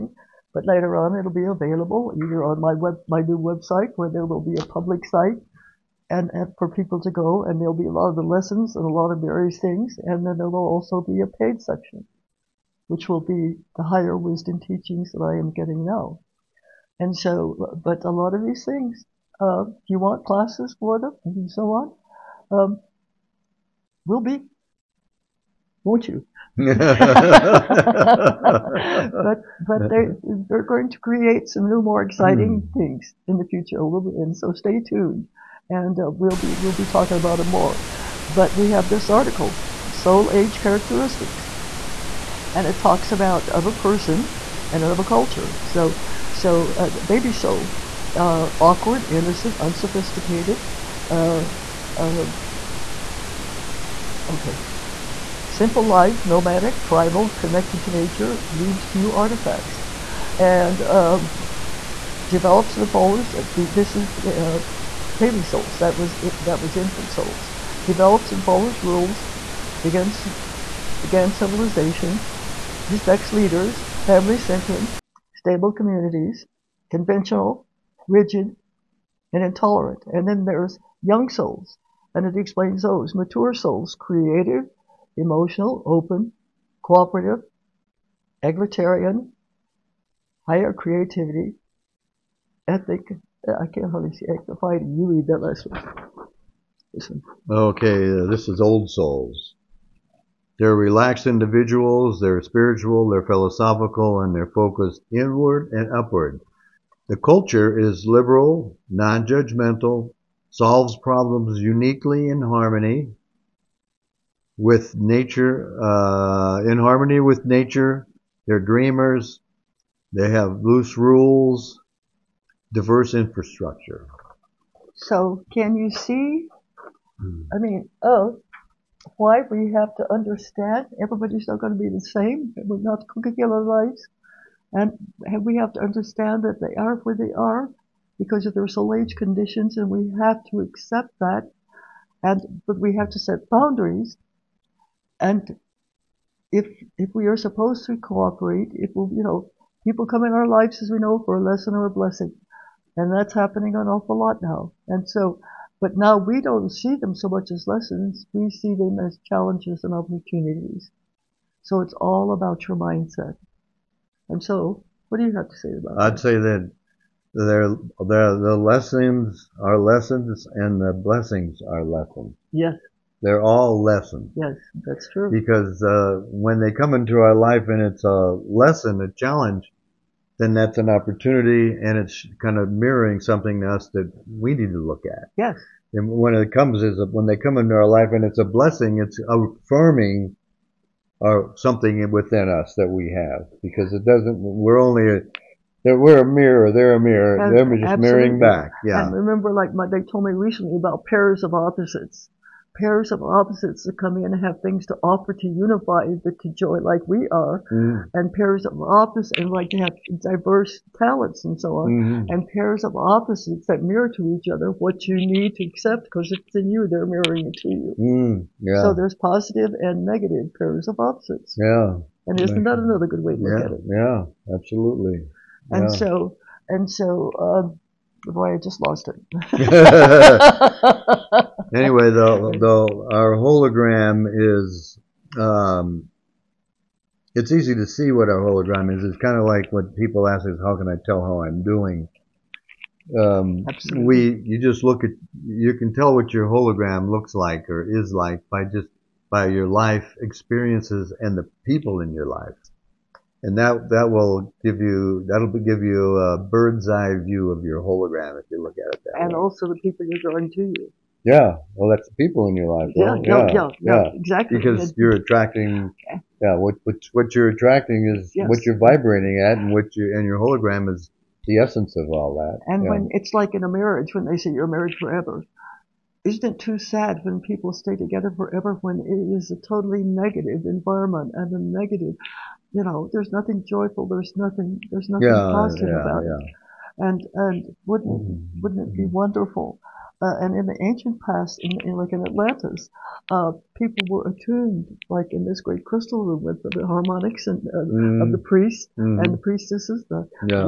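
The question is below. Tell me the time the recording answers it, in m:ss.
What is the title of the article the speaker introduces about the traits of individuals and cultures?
0:39.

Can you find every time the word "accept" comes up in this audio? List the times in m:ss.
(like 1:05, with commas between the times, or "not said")
2:20, 3:35.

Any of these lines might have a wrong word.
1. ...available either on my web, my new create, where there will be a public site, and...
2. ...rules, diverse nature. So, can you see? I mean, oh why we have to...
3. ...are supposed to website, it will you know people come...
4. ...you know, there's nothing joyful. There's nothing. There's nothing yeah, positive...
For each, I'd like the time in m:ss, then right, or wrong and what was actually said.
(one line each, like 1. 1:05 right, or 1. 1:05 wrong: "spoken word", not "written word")
1. 0:01 wrong: "website", not "create"
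2. 2:00 wrong: "infrastructure", not "nature"
3. 2:27 wrong: "cooperate", not "website"
4. 4:42 right.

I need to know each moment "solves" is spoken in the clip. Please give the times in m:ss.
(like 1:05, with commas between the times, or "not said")
1:50.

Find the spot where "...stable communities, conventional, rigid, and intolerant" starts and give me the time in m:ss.
1:15.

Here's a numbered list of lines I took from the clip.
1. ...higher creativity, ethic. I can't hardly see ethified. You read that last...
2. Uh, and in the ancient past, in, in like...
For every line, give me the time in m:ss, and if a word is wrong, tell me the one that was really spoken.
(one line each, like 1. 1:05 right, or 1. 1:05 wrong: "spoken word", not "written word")
1. 1:30 right
2. 4:50 right.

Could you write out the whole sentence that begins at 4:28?
what you're vibrating at, and what you and your hologram is the essence of all that.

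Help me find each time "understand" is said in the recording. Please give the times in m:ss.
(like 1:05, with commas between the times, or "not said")
2:10, 2:15.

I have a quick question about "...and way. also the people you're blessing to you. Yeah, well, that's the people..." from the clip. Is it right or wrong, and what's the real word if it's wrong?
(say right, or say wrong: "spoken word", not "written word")
wrong: "drawing", not "blessing".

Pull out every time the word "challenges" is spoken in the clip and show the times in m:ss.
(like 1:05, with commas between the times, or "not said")
2:39, 2:59.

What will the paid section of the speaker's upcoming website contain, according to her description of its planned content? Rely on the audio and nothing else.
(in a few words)
Higher wisdom teachings.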